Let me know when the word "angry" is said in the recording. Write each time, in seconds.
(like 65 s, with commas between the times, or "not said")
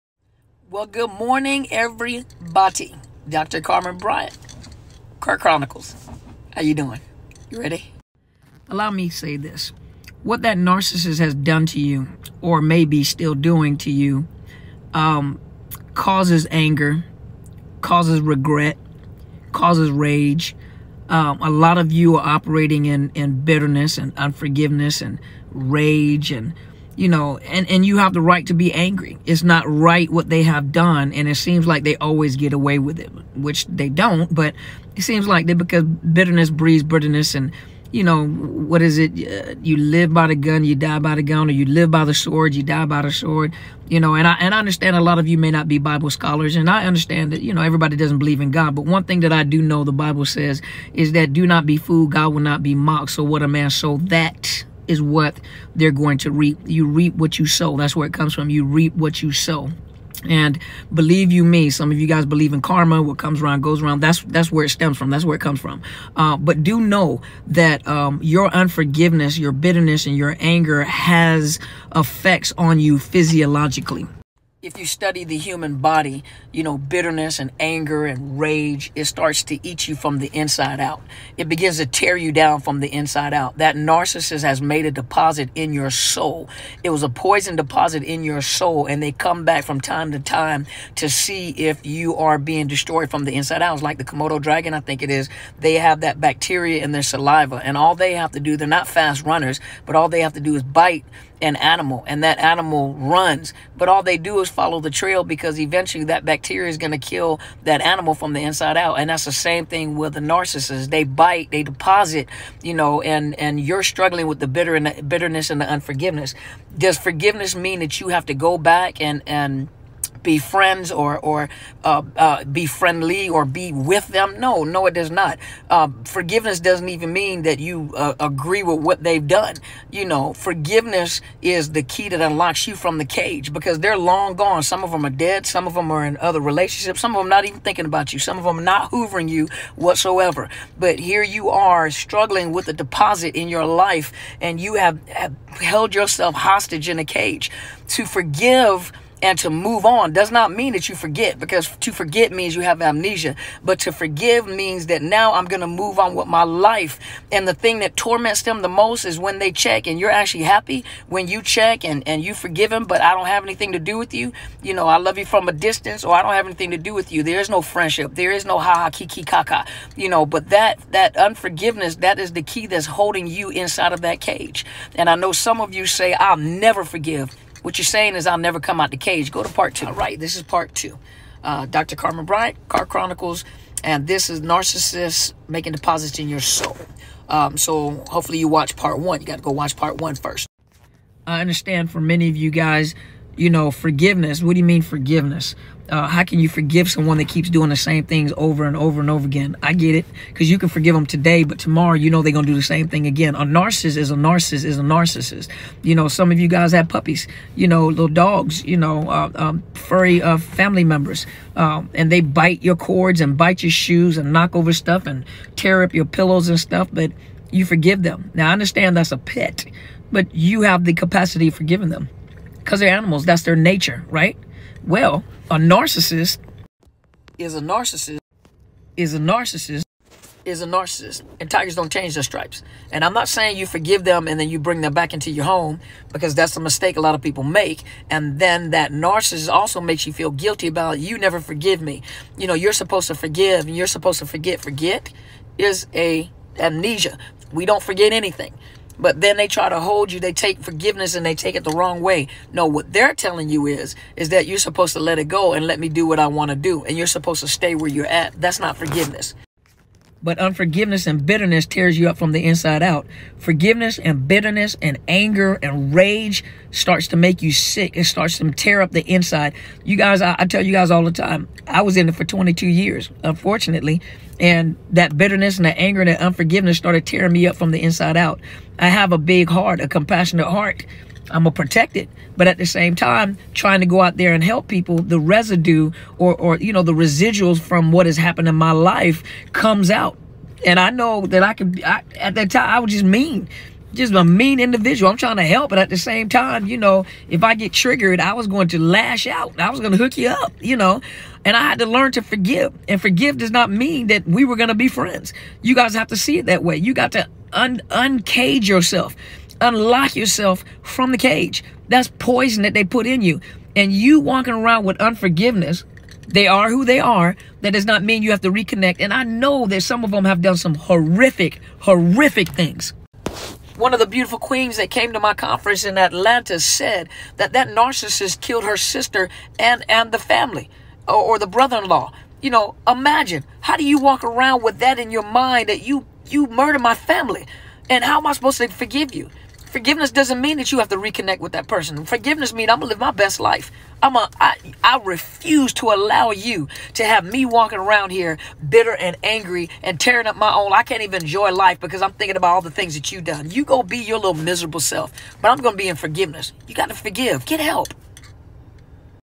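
28 s, 349 s.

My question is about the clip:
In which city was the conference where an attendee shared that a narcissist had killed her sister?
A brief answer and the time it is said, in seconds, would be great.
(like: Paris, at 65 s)
Atlanta, at 325 s.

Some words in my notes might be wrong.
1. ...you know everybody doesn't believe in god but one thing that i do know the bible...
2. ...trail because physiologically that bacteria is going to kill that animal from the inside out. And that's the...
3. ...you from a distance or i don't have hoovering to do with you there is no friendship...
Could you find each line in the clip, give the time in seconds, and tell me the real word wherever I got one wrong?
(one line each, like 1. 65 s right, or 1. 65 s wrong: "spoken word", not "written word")
1. 47 s right
2. 104 s wrong: "eventually", not "physiologically"
3. 165 s wrong: "anything", not "hoovering".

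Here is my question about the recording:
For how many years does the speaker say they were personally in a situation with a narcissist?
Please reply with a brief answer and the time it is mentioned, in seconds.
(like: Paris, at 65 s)
22, at 272 s.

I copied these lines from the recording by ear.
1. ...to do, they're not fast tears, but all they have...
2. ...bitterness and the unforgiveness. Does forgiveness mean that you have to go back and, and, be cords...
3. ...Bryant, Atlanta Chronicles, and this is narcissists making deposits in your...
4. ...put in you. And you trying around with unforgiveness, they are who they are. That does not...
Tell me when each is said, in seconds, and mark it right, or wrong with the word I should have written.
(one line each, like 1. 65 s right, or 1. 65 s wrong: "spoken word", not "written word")
1. 98 s wrong: "runners", not "tears"
2. 115 s wrong: "friends", not "cords"
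3. 182 s wrong: "Car", not "Atlanta"
4. 312 s wrong: "walking", not "trying".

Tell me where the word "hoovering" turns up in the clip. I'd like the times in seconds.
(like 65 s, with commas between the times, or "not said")
138 s.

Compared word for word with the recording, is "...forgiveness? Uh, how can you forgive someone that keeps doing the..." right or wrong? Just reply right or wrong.
right.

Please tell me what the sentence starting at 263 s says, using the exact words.
Forgiveness and bitterness and anger and rage starts to make you sick.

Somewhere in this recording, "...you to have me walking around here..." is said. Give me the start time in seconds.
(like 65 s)
346 s.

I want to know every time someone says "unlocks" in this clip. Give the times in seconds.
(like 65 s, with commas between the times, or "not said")
132 s, 309 s.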